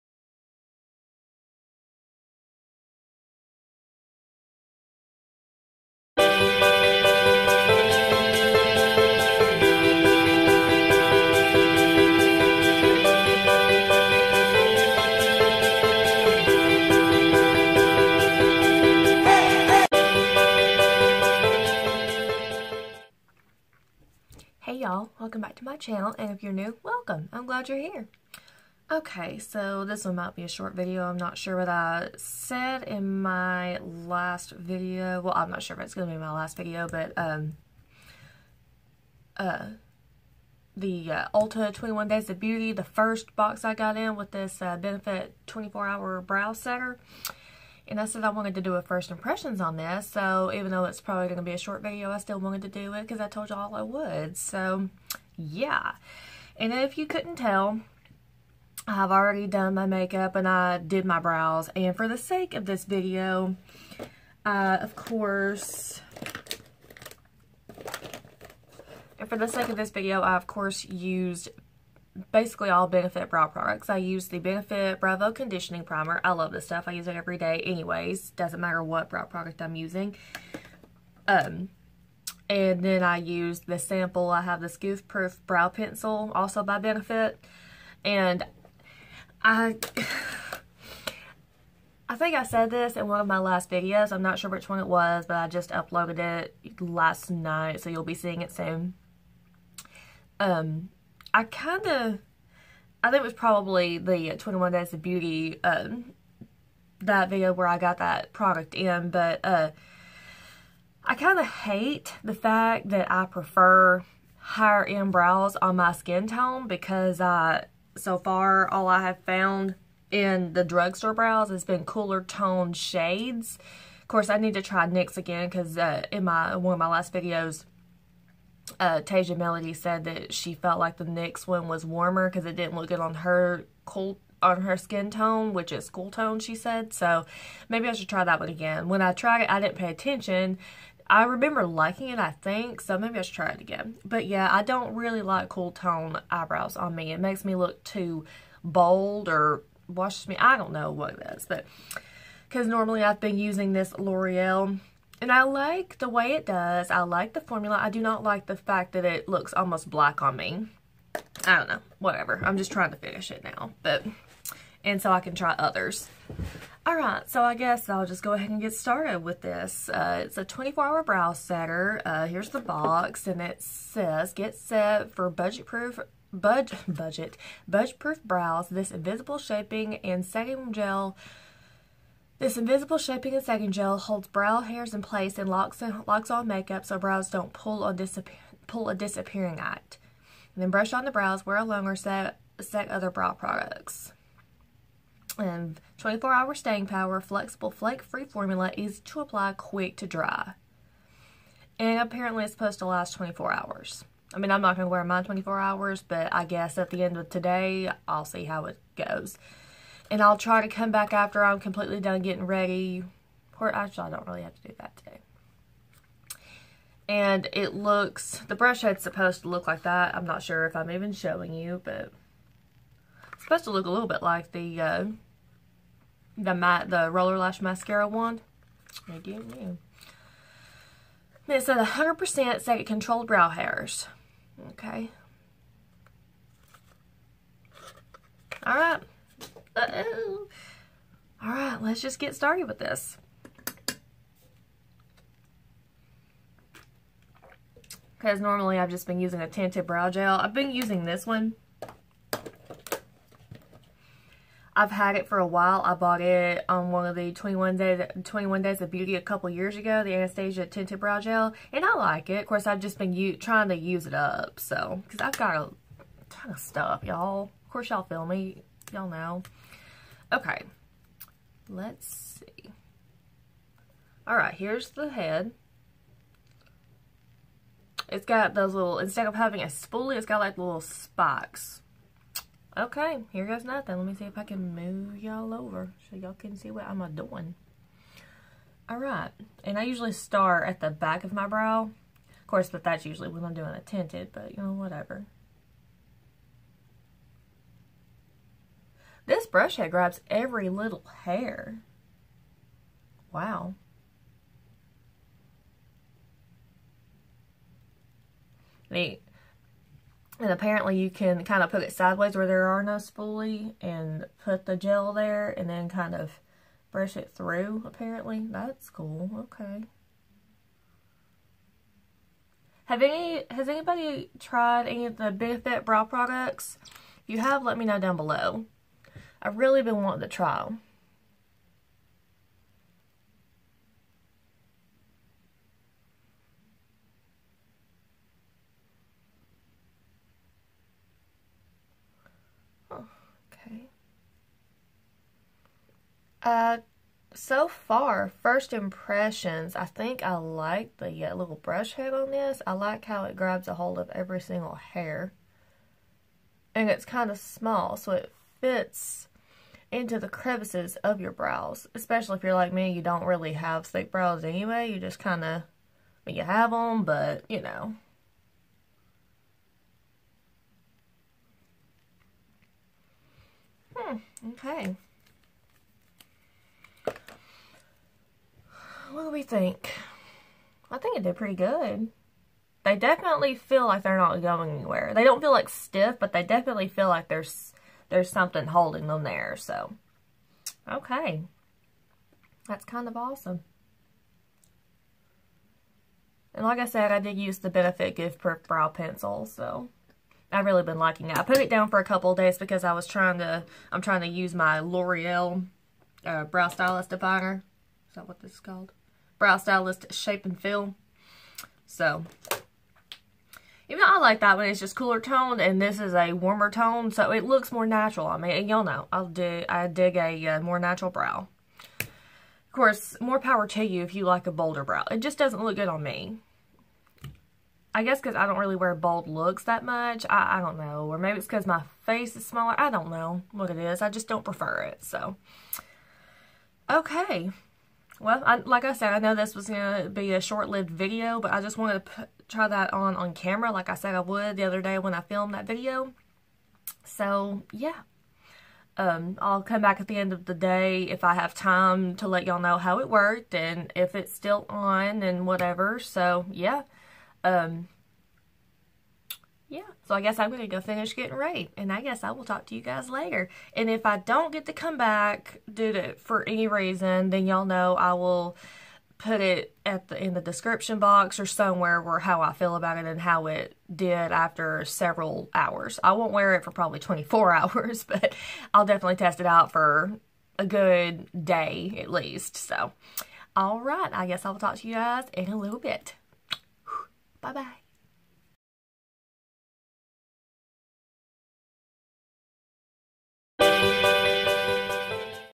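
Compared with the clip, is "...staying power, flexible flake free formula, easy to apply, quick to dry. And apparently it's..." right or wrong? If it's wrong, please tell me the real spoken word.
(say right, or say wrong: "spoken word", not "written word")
right.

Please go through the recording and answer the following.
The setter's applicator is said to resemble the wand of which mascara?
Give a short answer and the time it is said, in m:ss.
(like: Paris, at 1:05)
Roller Lash, at 3:47.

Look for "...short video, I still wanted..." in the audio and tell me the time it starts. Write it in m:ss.
0:51.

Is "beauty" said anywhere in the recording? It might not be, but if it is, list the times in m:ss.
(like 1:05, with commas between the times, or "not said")
0:42, 1:45, 4:18.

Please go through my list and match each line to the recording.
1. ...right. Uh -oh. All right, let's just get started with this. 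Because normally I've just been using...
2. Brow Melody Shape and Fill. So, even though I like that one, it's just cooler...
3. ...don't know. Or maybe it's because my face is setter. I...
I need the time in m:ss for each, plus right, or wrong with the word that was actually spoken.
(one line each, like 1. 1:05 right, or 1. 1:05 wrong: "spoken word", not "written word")
1. 3:58 right
2. 6:49 wrong: "Stylist", not "Melody"
3. 7:10 wrong: "smaller", not "setter".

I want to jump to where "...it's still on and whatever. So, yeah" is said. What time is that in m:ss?
7:34.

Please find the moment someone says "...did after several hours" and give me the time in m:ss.
7:53.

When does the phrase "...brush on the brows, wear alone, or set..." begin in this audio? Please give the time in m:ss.
3:10.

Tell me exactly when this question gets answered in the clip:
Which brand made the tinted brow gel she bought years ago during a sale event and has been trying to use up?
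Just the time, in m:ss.
4:20.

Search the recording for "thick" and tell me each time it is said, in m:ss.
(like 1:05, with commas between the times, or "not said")
6:03.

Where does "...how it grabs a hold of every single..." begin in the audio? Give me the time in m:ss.
5:53.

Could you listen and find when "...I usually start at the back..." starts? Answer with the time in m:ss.
4:49.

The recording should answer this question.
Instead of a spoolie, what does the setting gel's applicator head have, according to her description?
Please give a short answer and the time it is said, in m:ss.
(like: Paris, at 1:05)
little spikes, at 4:40.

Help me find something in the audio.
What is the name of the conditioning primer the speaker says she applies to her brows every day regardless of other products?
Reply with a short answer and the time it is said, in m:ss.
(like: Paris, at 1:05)
Browvo Conditioning Primer, at 1:14.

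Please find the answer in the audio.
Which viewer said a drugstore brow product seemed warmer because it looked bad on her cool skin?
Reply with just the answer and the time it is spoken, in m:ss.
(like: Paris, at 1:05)
Tasia Melody, at 2:09.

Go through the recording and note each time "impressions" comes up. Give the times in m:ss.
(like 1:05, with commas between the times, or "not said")
0:49, 5:48.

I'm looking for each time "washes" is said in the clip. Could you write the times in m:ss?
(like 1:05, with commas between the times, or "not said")
2:29.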